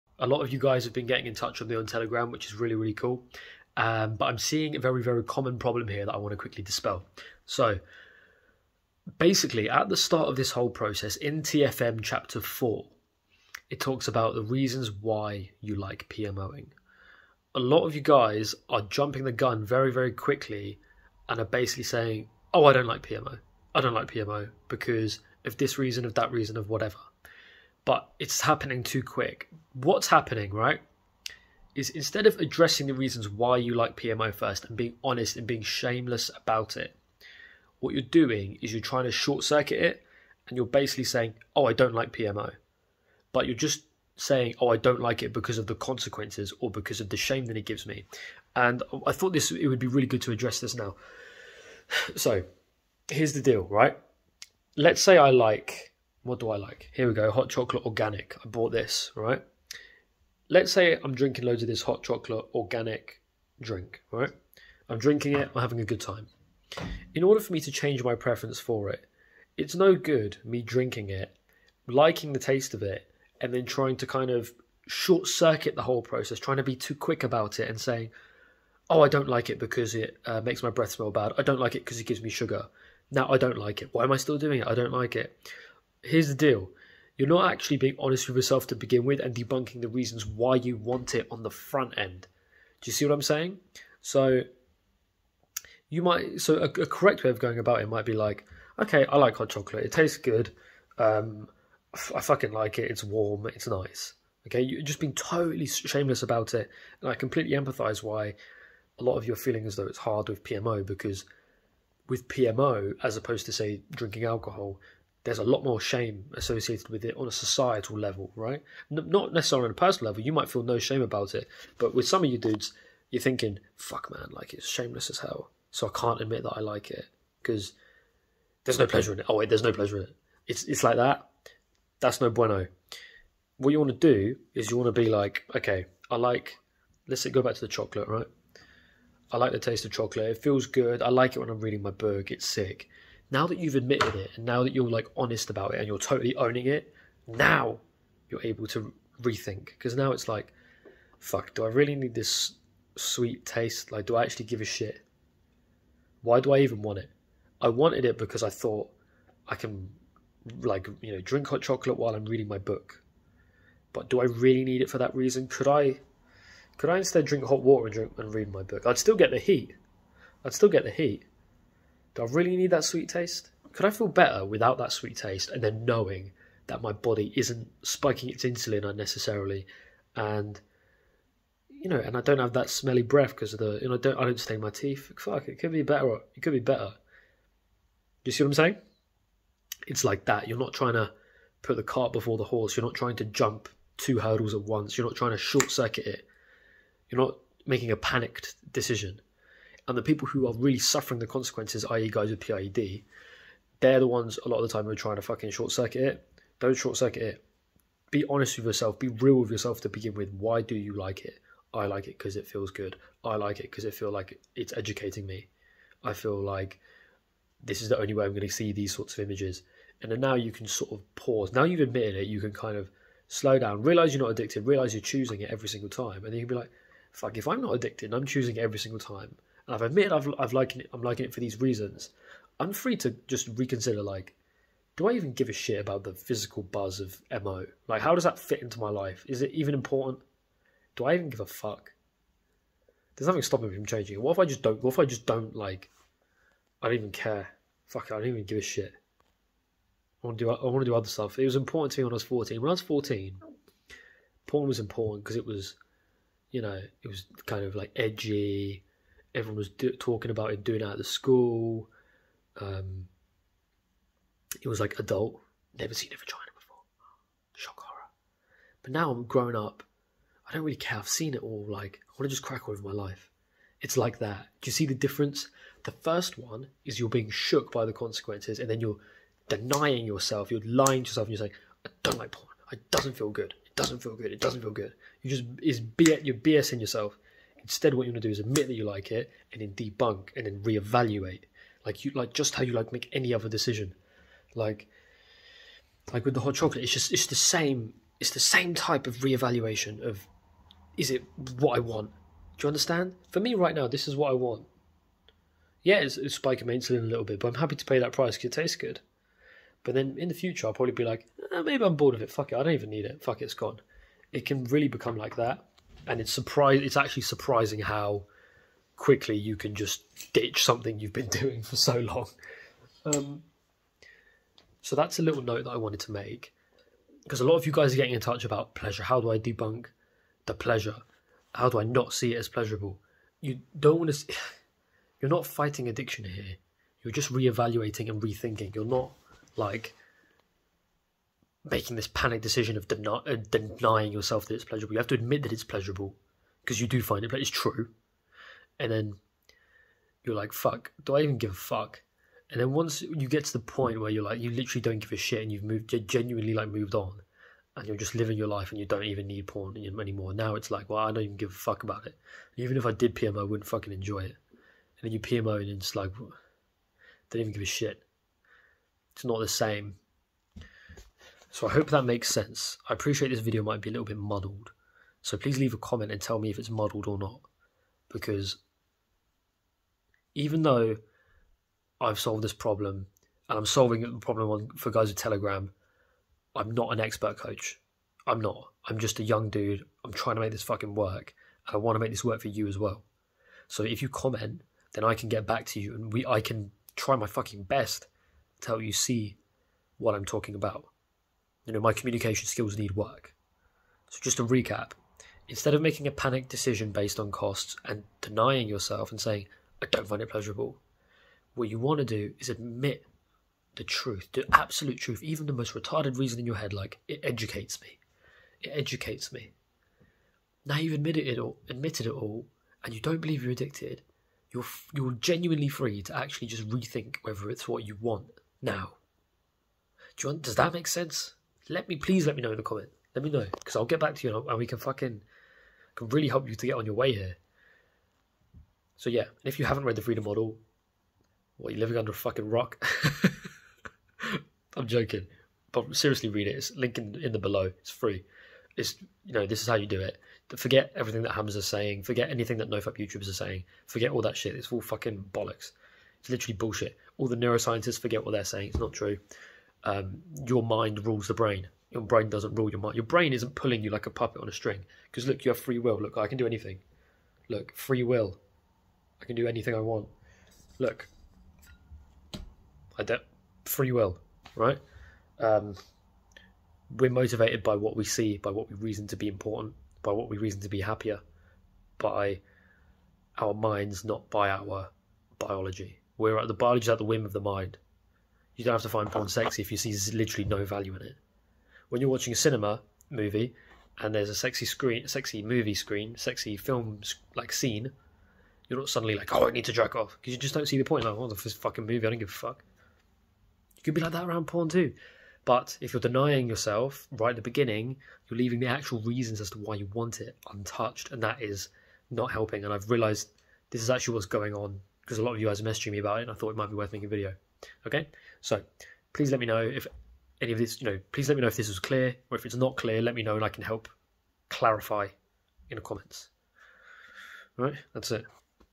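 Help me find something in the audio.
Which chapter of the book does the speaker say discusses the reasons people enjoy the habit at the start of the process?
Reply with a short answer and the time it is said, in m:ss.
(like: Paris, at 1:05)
Chapter 4, at 0:12.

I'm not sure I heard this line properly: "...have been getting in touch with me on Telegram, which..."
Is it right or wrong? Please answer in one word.
right.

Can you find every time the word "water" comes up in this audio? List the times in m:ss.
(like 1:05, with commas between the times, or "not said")
2:47.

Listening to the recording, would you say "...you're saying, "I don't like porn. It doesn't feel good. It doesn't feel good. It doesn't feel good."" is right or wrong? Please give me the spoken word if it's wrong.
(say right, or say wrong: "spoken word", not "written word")
right.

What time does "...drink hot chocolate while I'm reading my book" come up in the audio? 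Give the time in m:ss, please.
2:41.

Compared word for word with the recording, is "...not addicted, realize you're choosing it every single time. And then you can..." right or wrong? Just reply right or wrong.
right.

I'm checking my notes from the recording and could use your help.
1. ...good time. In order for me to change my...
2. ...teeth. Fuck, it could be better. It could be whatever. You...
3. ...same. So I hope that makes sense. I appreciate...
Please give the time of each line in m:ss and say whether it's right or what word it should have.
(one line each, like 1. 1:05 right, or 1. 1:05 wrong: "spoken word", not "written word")
1. 1:05 right
2. 3:04 wrong: "better", not "whatever"
3. 6:09 right.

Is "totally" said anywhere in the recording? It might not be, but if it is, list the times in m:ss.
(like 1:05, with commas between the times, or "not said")
1:45, 2:25.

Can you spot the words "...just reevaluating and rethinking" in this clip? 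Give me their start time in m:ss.
5:37.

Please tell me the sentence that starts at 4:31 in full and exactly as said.
Like I want to just crack on with my life.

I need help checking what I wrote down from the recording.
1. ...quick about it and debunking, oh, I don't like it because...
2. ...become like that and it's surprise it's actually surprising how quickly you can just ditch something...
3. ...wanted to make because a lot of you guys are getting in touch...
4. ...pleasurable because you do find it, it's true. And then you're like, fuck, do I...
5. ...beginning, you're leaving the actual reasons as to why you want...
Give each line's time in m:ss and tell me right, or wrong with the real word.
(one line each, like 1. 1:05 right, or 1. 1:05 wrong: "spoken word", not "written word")
1. 1:16 wrong: "saying", not "debunking"
2. 5:14 right
3. 5:25 right
4. 5:45 right
5. 8:27 right.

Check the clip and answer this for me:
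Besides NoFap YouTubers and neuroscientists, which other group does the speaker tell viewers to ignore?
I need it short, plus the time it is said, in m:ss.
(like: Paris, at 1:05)
Hams, at 7:31.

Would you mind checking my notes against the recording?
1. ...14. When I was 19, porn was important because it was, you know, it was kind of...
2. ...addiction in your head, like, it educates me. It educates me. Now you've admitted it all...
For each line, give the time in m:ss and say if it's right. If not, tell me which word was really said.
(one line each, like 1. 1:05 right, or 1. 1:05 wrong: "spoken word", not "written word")
1. 4:12 wrong: "14", not "19"
2. 6:56 wrong: "reason", not "addiction".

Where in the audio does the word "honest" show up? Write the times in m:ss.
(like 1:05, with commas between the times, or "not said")
0:35, 1:27, 2:25, 3:28.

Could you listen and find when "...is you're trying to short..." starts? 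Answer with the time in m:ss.
0:38.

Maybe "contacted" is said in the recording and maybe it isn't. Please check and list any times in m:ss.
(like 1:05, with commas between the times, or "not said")
not said.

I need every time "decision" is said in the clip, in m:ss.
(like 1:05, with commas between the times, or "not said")
3:18, 4:53, 5:42, 6:46.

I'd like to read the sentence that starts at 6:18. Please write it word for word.
Because even though I've solved this problem and I'm solving the problem on, for guys with Telegram, I'm not an expert coach.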